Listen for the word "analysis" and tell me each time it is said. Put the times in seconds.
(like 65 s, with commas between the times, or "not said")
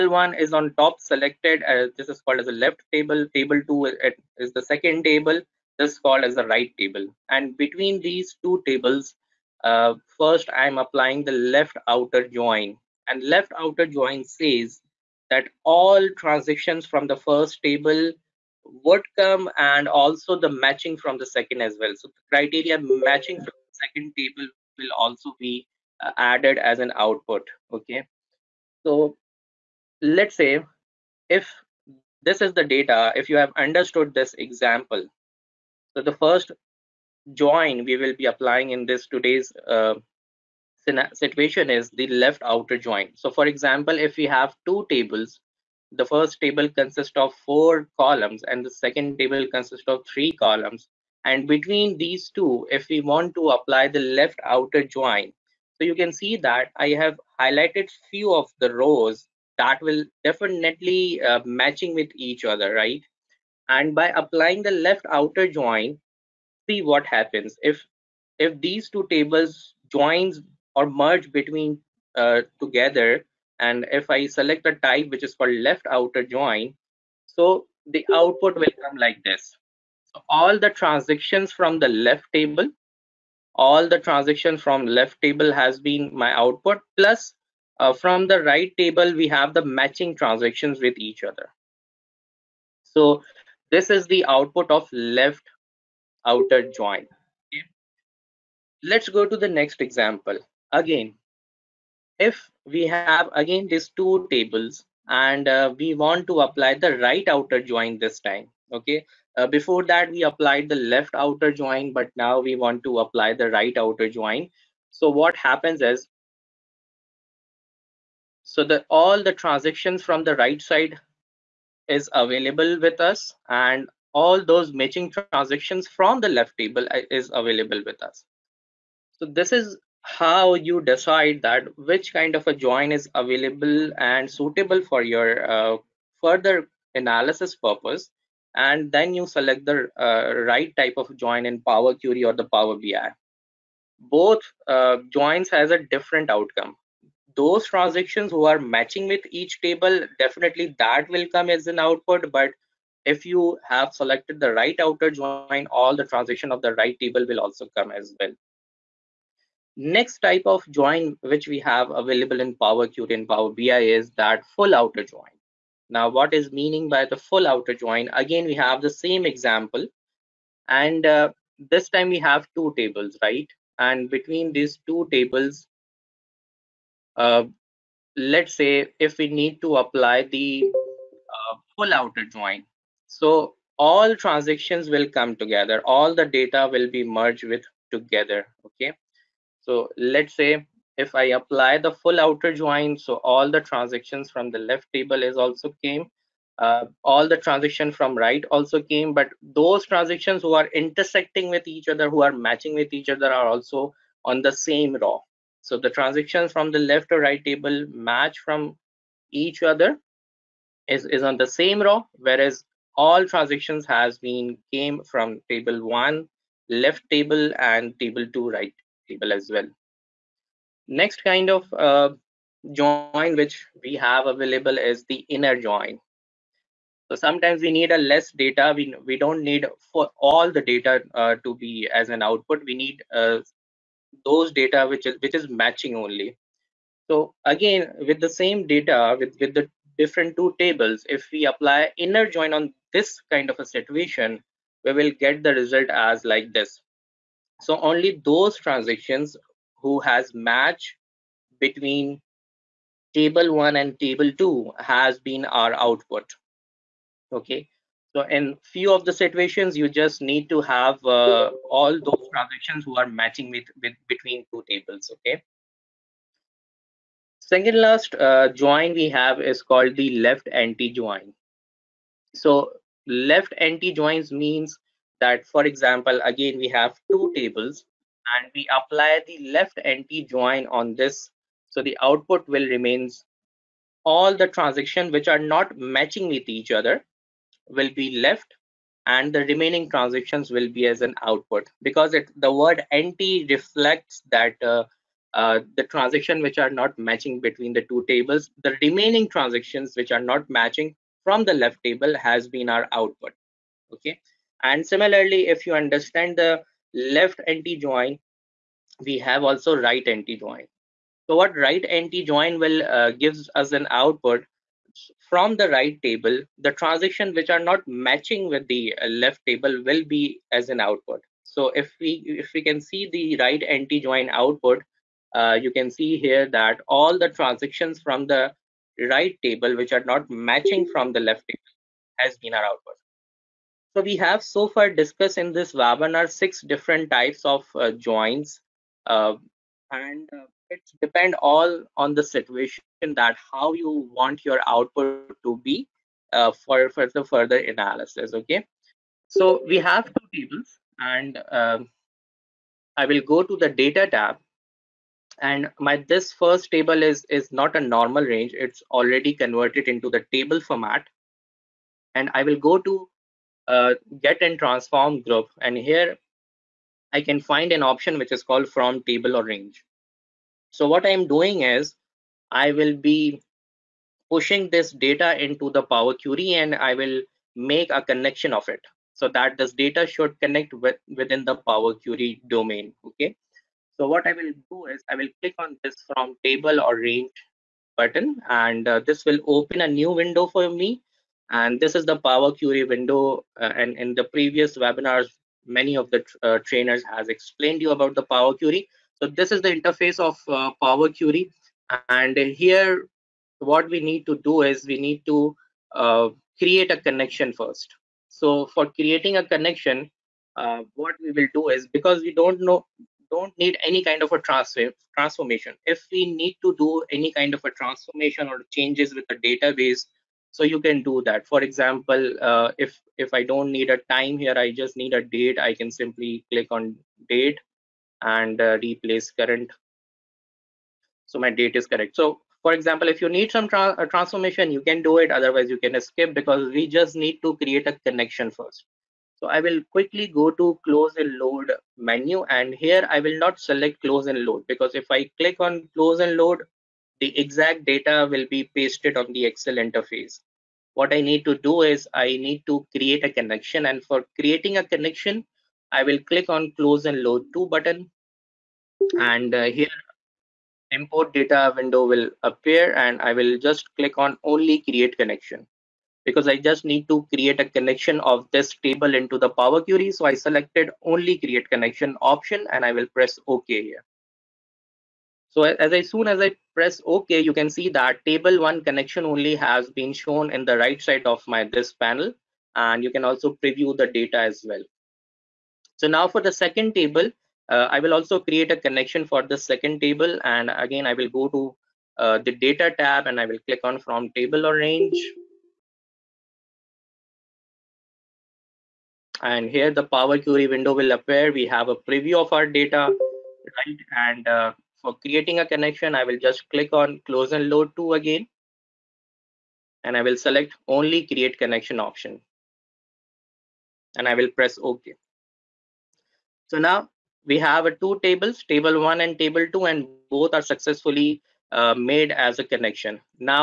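136 s, 347 s.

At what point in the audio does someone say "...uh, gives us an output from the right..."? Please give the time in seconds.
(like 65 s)
312 s.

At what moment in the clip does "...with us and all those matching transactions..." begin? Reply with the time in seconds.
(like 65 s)
122 s.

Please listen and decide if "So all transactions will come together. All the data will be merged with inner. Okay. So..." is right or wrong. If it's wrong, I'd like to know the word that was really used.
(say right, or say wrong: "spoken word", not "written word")
wrong: "together", not "inner".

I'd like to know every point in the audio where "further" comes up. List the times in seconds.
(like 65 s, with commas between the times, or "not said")
136 s, 347 s.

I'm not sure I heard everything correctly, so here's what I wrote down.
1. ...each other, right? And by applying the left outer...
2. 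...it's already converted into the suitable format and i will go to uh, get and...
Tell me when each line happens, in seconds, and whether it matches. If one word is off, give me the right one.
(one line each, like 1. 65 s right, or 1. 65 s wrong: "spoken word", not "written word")
1. 62 s right
2. 358 s wrong: "table", not "suitable".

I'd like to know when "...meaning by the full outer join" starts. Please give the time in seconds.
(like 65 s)
166 s.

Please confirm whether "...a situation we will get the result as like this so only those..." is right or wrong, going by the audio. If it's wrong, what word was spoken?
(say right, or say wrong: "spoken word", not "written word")
right.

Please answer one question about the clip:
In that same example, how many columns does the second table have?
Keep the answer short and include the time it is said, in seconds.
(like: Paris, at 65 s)
3, at 50 s.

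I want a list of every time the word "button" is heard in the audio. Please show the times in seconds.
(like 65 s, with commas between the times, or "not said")
387 s, 457 s.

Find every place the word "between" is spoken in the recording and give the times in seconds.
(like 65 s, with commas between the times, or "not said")
7 s, 51 s, 71 s, 174 s, 251 s, 264 s, 297 s.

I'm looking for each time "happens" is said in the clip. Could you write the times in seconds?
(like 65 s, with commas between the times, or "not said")
67 s, 115 s.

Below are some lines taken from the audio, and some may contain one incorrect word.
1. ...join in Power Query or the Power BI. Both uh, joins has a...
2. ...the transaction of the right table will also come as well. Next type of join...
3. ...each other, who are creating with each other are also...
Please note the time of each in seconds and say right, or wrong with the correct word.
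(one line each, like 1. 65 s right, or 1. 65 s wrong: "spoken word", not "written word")
1. 141 s right
2. 155 s right
3. 201 s wrong: "matching", not "creating".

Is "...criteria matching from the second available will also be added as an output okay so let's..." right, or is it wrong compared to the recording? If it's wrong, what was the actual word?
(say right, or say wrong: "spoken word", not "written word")
wrong: "table", not "available".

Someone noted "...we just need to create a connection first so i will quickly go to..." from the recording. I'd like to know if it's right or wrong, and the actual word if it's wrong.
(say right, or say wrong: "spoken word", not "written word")
right.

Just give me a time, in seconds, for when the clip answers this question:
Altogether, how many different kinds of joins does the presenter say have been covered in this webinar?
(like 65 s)
336 s.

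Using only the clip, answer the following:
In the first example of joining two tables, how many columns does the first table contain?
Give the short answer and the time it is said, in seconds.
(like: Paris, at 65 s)
4, at 47 s.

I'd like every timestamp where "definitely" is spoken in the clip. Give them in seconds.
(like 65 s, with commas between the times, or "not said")
60 s, 150 s.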